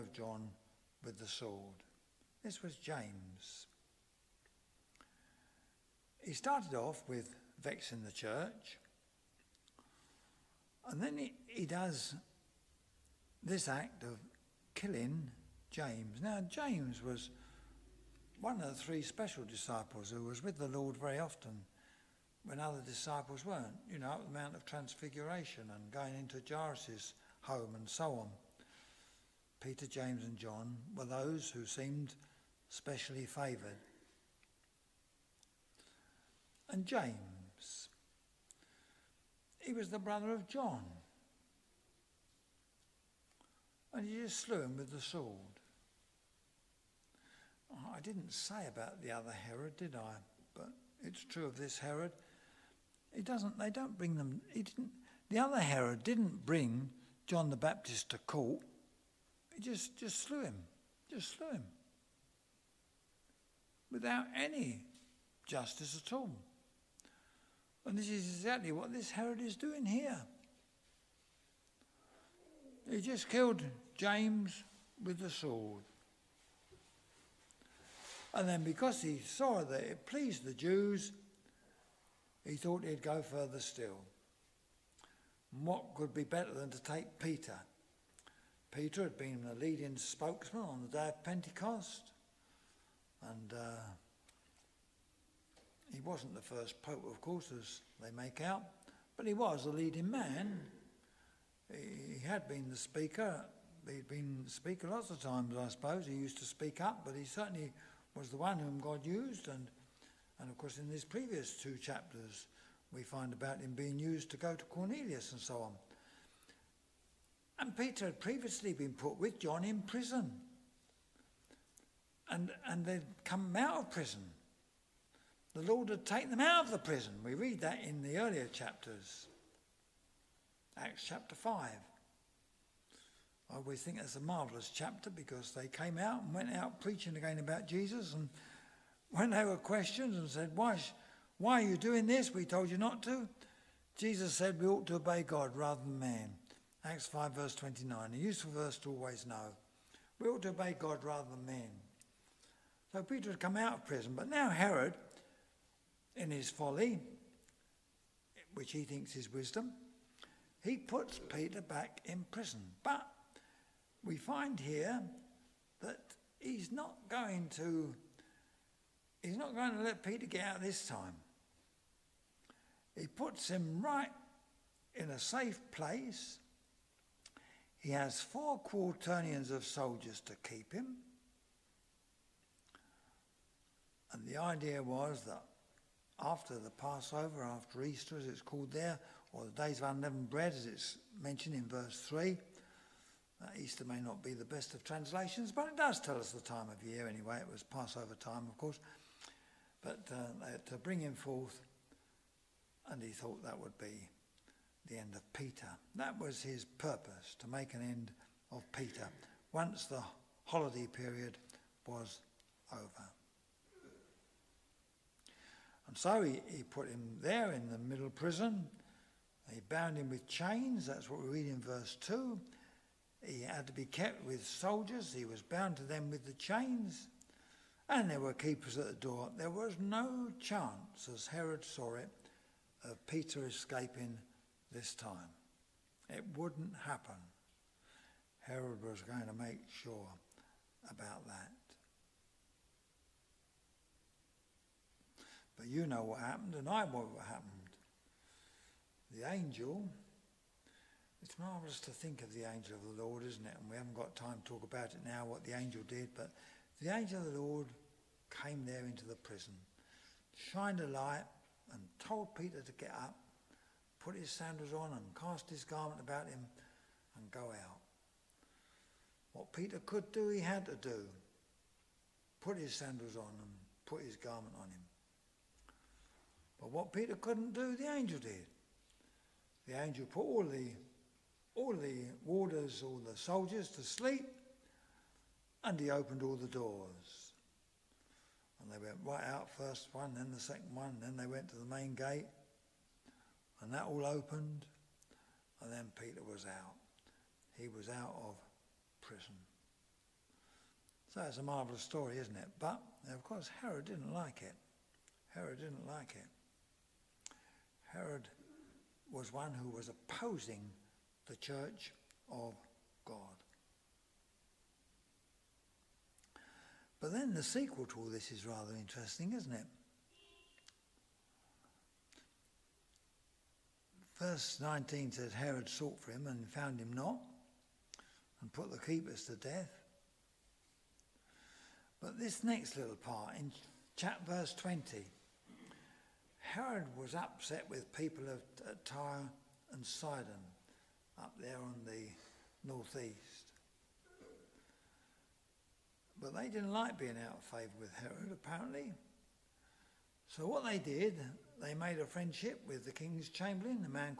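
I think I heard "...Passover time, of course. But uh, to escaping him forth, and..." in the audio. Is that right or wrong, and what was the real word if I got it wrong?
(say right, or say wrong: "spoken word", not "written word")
wrong: "bring", not "escaping".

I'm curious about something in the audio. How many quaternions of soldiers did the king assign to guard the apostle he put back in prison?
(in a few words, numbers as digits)
4.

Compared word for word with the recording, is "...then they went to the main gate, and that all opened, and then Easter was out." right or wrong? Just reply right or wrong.
wrong.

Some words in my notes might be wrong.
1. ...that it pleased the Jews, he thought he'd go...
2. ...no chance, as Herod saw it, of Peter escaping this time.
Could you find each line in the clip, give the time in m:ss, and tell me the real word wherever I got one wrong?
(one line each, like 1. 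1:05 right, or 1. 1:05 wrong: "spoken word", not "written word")
1. 1:19 right
2. 3:49 right.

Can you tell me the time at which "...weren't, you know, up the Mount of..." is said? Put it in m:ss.
0:23.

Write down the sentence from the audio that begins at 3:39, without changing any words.
He bound him with chains, that's what we read in verse 2.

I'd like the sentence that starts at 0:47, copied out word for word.
Oh, I didn't say about the other Herod, did I?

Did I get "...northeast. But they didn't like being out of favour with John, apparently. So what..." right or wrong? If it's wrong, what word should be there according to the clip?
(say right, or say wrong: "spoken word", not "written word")
wrong: "Herod", not "John".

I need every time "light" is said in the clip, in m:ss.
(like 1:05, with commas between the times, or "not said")
4:20.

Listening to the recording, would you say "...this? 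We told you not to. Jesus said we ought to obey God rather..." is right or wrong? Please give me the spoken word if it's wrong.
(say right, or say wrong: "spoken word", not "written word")
right.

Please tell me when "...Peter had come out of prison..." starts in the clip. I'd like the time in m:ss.
2:33.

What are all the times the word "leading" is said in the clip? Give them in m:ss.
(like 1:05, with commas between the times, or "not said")
1:29, 1:39.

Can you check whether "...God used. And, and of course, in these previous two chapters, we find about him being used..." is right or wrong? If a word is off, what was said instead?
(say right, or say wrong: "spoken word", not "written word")
right.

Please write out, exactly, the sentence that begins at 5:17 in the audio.
But then the sequel to all this is rather interesting, isn't it?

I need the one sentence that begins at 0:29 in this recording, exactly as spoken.
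Peter, James, and John were those who seemed specially favoured.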